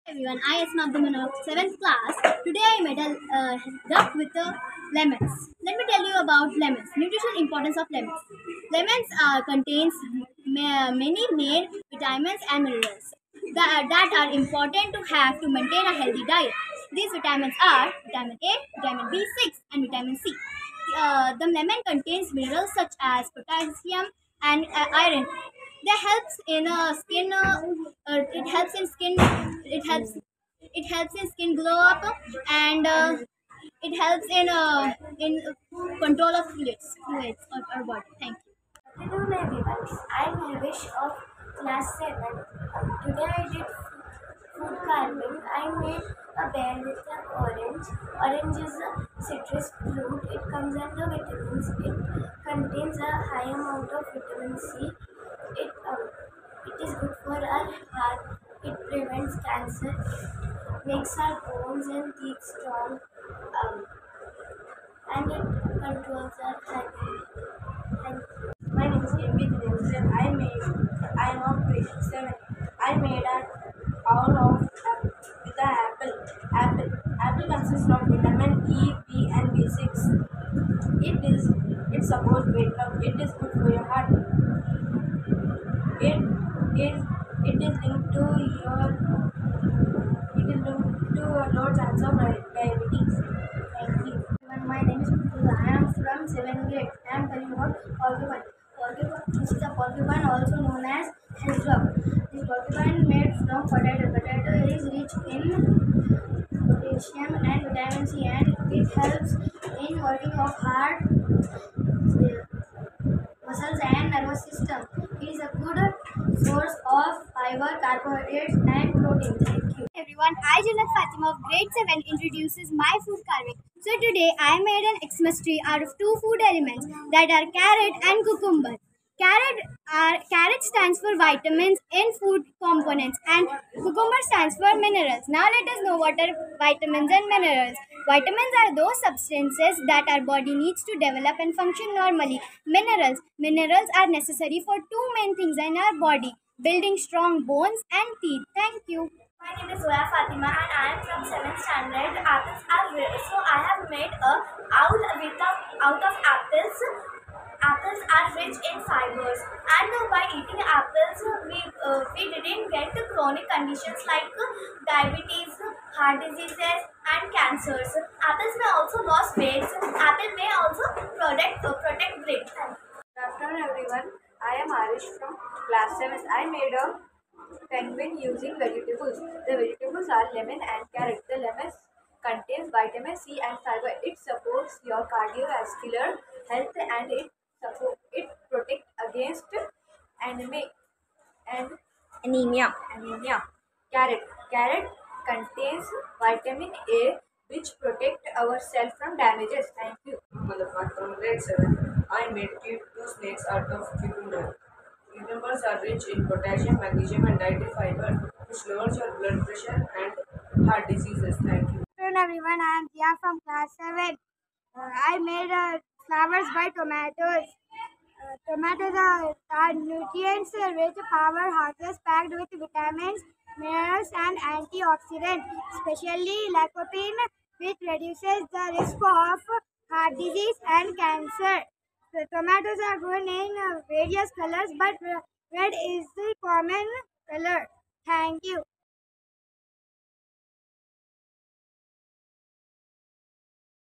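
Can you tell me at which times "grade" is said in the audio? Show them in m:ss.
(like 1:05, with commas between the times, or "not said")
1:36, 2:01, 3:21.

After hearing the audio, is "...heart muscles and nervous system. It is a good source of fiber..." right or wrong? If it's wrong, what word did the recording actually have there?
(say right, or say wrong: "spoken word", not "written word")
right.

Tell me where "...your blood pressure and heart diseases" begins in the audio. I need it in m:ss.
3:28.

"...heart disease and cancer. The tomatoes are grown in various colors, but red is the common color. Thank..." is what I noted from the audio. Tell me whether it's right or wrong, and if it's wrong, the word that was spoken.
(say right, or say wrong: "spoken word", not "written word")
right.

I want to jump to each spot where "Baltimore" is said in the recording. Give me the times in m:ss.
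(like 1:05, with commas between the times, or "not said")
not said.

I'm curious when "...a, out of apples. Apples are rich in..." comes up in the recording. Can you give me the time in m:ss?
2:35.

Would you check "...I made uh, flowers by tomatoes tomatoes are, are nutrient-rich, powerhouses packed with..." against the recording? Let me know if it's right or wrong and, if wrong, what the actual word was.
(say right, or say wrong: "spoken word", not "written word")
right.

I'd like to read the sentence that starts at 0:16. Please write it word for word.
These vitamins are vitamin A, vitamin B6 and vitamin C.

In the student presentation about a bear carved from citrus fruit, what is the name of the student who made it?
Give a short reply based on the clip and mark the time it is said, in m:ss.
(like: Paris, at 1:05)
Hivish, at 0:40.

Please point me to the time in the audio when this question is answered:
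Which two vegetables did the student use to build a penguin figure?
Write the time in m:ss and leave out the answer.
3:00.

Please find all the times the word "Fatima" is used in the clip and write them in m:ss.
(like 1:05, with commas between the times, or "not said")
2:00, 2:30.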